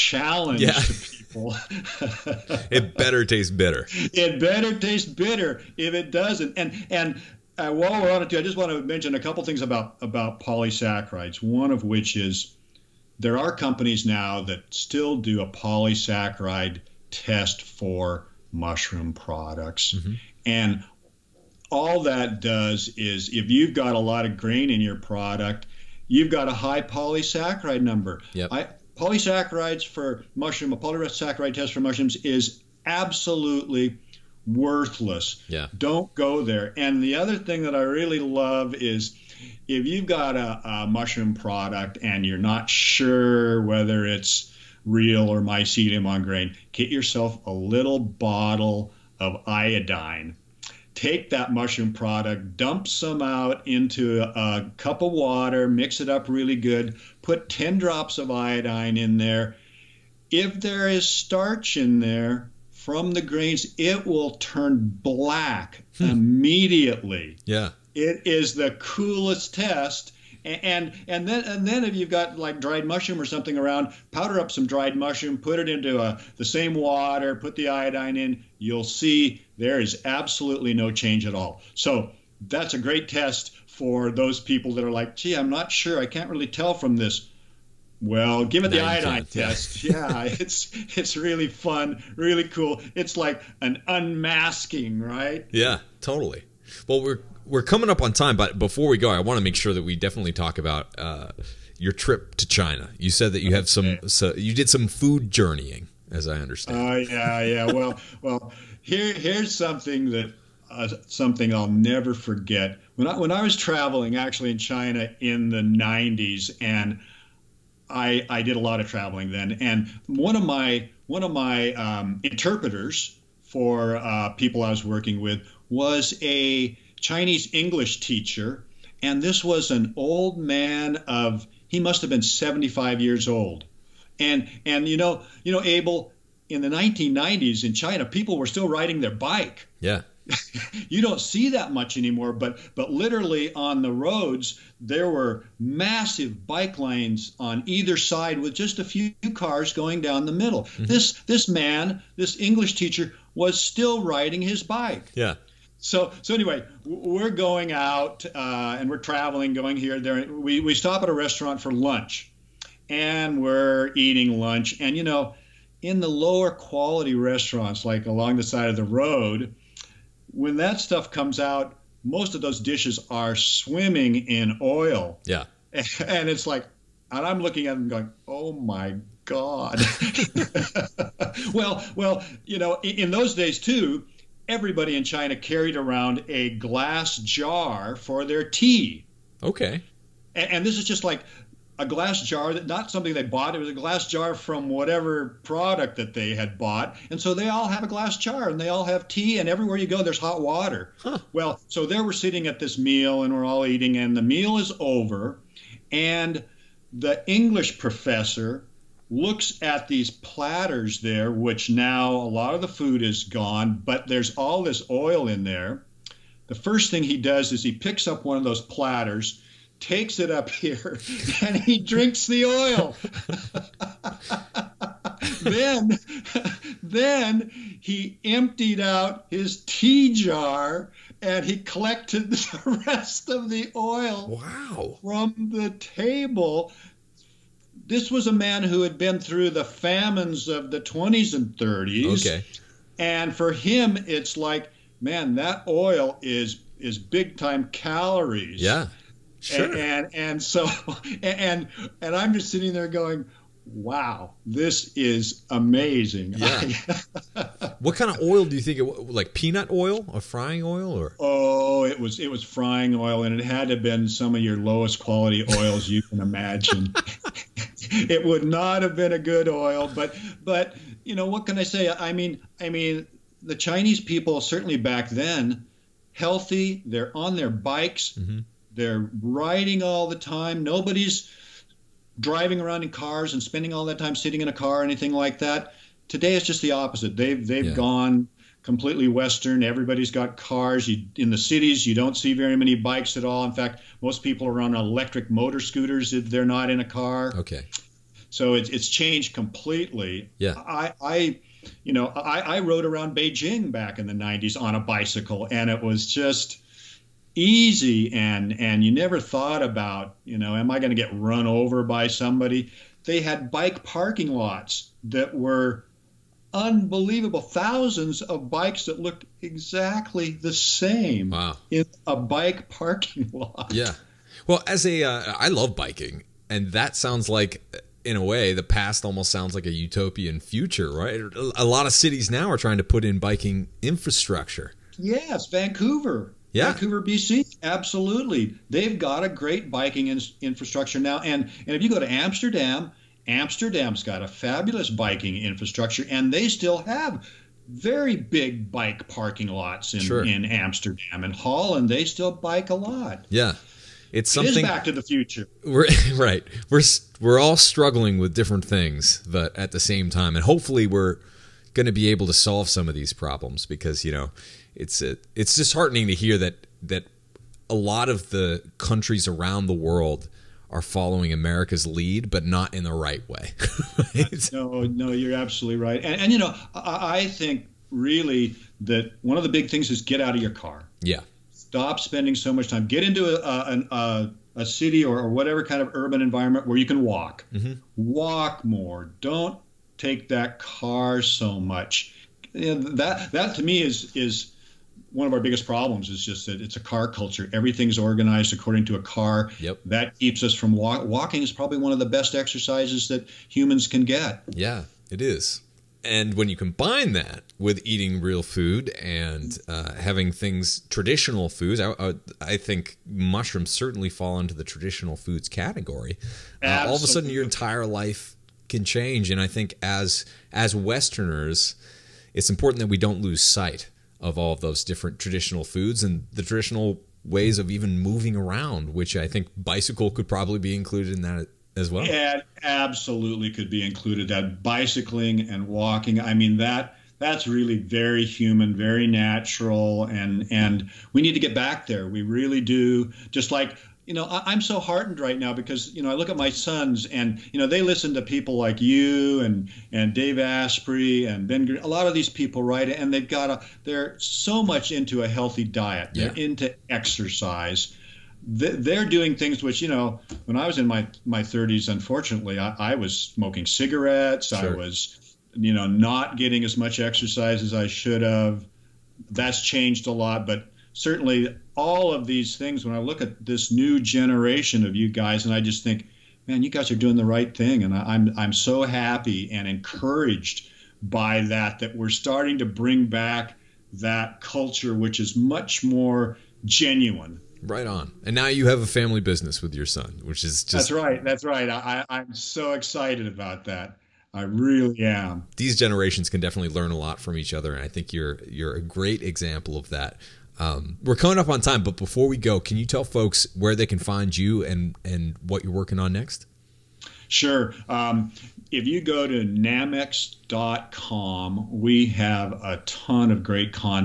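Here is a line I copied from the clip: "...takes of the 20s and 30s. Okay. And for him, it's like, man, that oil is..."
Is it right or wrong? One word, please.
wrong.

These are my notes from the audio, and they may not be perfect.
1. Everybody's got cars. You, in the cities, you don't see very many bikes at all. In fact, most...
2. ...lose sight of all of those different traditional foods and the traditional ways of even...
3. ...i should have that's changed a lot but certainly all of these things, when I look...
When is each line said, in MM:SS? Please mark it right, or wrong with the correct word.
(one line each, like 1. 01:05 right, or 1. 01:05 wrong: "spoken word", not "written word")
1. 04:49 right
2. 07:03 right
3. 07:47 right.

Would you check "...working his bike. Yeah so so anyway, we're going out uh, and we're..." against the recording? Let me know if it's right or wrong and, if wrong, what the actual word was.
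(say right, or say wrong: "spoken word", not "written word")
wrong: "riding", not "working".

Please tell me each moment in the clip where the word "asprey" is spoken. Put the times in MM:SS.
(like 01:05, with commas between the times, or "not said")
07:30.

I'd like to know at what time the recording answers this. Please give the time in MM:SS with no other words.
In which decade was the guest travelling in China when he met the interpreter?
01:55.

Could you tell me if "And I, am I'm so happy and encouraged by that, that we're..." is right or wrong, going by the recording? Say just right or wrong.
right.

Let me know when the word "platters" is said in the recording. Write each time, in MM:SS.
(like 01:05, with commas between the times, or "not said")
03:30, 03:38.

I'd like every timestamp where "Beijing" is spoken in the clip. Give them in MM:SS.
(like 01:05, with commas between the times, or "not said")
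05:03.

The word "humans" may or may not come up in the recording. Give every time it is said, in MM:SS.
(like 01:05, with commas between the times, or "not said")
06:43, 07:18.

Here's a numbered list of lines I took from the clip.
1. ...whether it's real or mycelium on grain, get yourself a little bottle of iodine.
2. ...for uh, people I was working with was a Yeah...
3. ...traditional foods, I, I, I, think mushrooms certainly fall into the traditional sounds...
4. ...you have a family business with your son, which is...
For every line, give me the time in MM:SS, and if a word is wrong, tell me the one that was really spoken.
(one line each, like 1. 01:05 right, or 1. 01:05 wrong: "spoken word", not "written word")
1. 00:43 right
2. 02:03 wrong: "Chinese", not "Yeah"
3. 06:50 wrong: "foods", not "sounds"
4. 08:08 right.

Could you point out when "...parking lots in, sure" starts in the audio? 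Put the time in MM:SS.
05:49.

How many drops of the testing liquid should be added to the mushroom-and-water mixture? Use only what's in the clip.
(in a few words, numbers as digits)
10.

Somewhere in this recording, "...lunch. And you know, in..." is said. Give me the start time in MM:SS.
02:44.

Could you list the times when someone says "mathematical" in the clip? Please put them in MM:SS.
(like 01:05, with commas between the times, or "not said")
not said.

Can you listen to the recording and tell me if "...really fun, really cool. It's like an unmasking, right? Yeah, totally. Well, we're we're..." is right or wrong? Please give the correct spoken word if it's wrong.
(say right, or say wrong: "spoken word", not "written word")
right.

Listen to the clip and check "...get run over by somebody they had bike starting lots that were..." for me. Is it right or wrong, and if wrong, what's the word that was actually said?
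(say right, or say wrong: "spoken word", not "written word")
wrong: "parking", not "starting".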